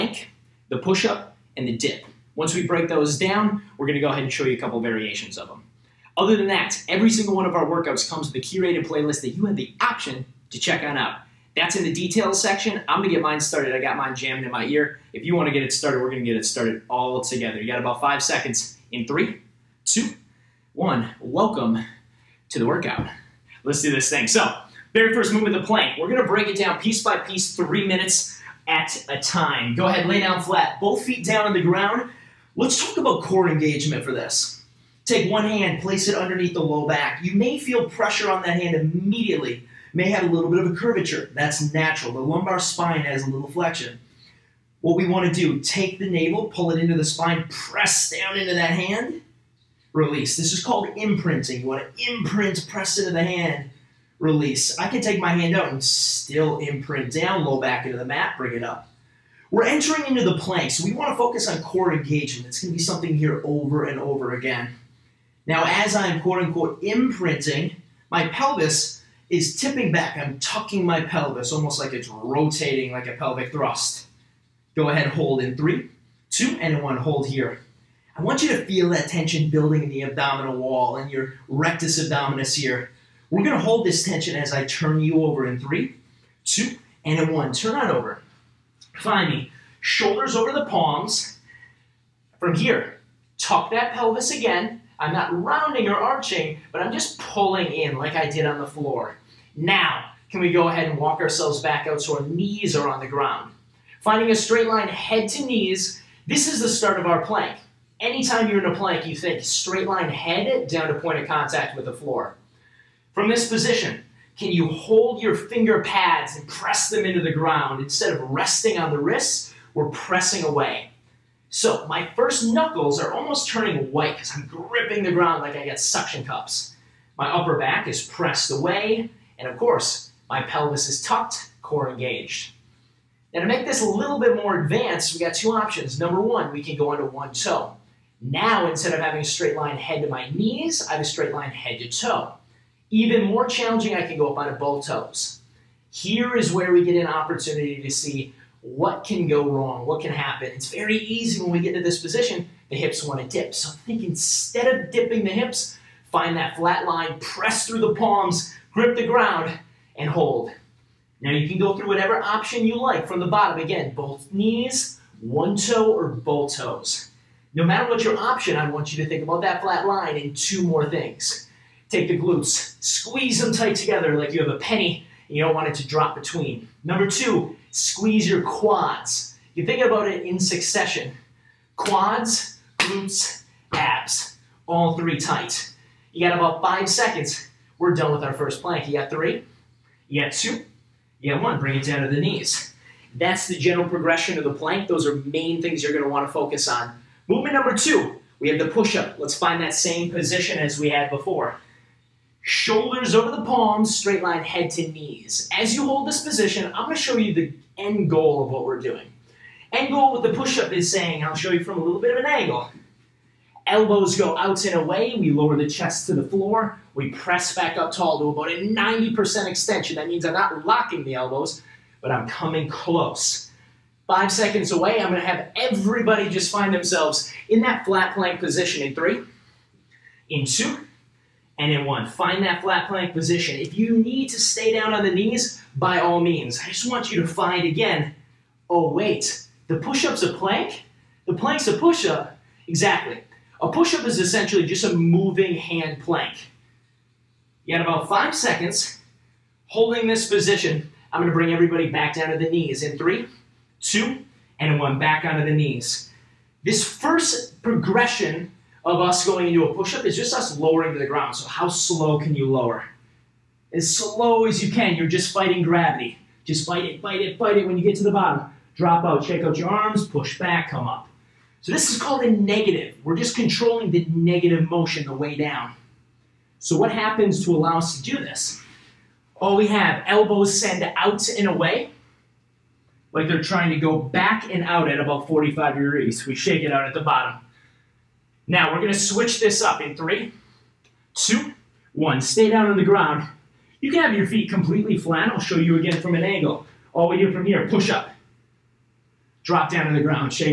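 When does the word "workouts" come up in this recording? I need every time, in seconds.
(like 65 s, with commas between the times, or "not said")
7 s, 22 s.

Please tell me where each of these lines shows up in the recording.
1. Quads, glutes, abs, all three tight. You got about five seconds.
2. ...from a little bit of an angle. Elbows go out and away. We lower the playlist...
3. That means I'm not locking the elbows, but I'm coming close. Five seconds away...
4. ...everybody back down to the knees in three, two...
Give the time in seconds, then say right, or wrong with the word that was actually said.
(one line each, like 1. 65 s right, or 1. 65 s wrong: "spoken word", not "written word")
1. 181 s right
2. 211 s wrong: "chest", not "playlist"
3. 219 s right
4. 251 s right.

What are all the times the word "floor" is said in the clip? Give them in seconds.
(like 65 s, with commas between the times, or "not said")
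98 s, 111 s, 216 s.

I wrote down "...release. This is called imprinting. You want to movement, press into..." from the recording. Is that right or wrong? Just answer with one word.
wrong.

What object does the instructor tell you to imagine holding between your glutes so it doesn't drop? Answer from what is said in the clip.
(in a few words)
A penny.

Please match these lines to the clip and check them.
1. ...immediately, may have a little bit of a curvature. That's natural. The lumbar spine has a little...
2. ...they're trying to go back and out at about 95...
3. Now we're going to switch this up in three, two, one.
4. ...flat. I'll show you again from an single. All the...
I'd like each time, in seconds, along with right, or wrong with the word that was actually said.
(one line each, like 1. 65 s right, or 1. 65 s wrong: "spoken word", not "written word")
1. 38 s right
2. 283 s wrong: "45", not "95"
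3. 288 s right
4. 294 s wrong: "angle", not "single".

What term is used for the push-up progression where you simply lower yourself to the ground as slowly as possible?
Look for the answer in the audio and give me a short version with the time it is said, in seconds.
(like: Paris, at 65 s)
A negative, at 271 s.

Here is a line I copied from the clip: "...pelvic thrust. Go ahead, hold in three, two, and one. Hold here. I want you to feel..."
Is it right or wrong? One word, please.
right.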